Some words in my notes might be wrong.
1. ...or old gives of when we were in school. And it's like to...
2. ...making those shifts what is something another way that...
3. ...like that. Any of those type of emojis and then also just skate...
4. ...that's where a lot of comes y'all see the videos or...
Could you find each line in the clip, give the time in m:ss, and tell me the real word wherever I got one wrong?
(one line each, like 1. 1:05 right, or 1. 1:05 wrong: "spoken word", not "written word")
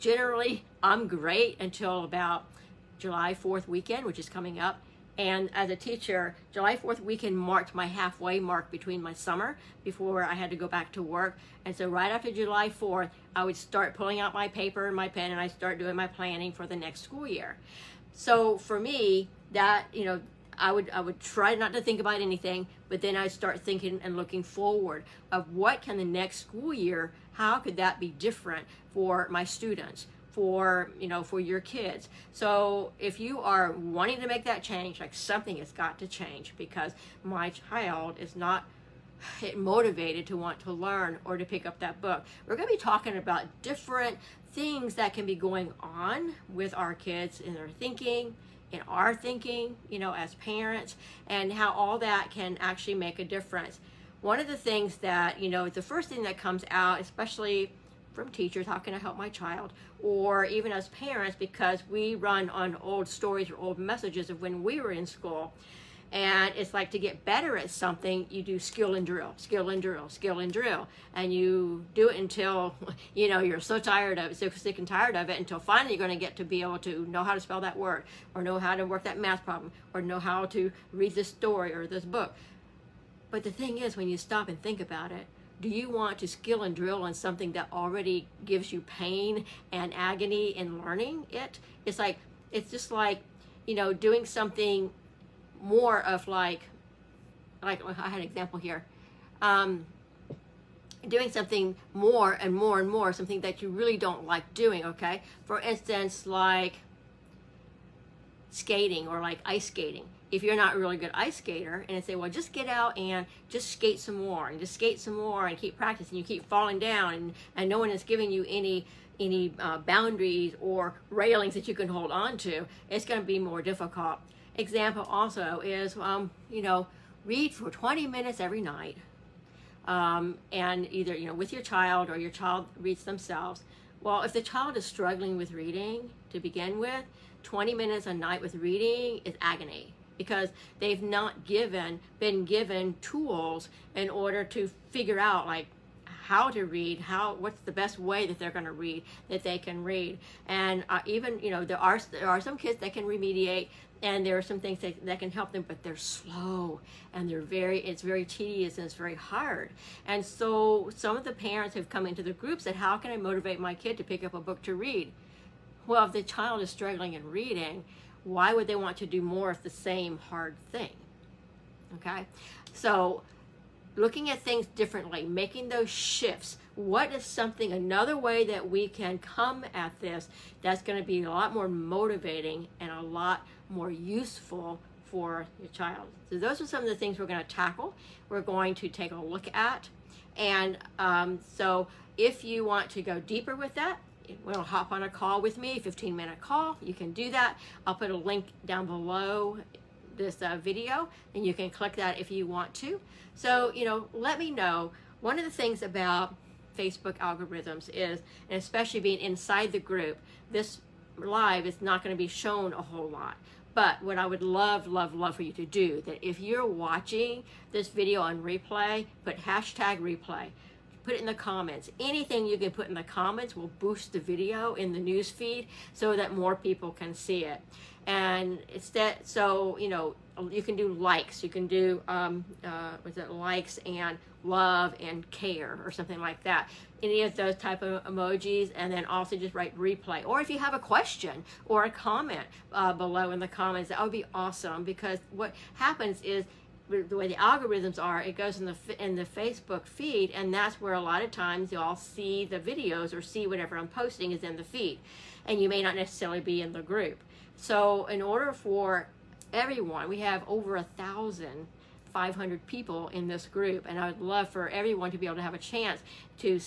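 1. 1:03 wrong: "messages", not "gives"
2. 2:55 right
3. 3:56 wrong: "write", not "skate"
4. 4:10 wrong: "times", not "comes".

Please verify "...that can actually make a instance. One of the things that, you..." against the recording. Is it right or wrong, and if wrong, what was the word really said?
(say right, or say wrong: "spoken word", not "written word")
wrong: "difference", not "instance".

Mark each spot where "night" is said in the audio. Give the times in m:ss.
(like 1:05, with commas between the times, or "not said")
2:08, 2:18.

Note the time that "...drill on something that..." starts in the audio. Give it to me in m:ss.
1:26.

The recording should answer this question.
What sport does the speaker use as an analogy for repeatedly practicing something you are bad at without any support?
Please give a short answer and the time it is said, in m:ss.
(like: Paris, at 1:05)
ice skating, at 1:49.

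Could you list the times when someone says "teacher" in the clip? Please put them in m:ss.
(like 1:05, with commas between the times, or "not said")
0:05, 0:58.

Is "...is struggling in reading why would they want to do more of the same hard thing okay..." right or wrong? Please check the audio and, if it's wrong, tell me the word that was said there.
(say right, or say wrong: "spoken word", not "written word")
right.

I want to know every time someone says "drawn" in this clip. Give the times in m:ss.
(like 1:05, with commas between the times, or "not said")
not said.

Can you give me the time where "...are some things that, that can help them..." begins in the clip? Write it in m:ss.
2:34.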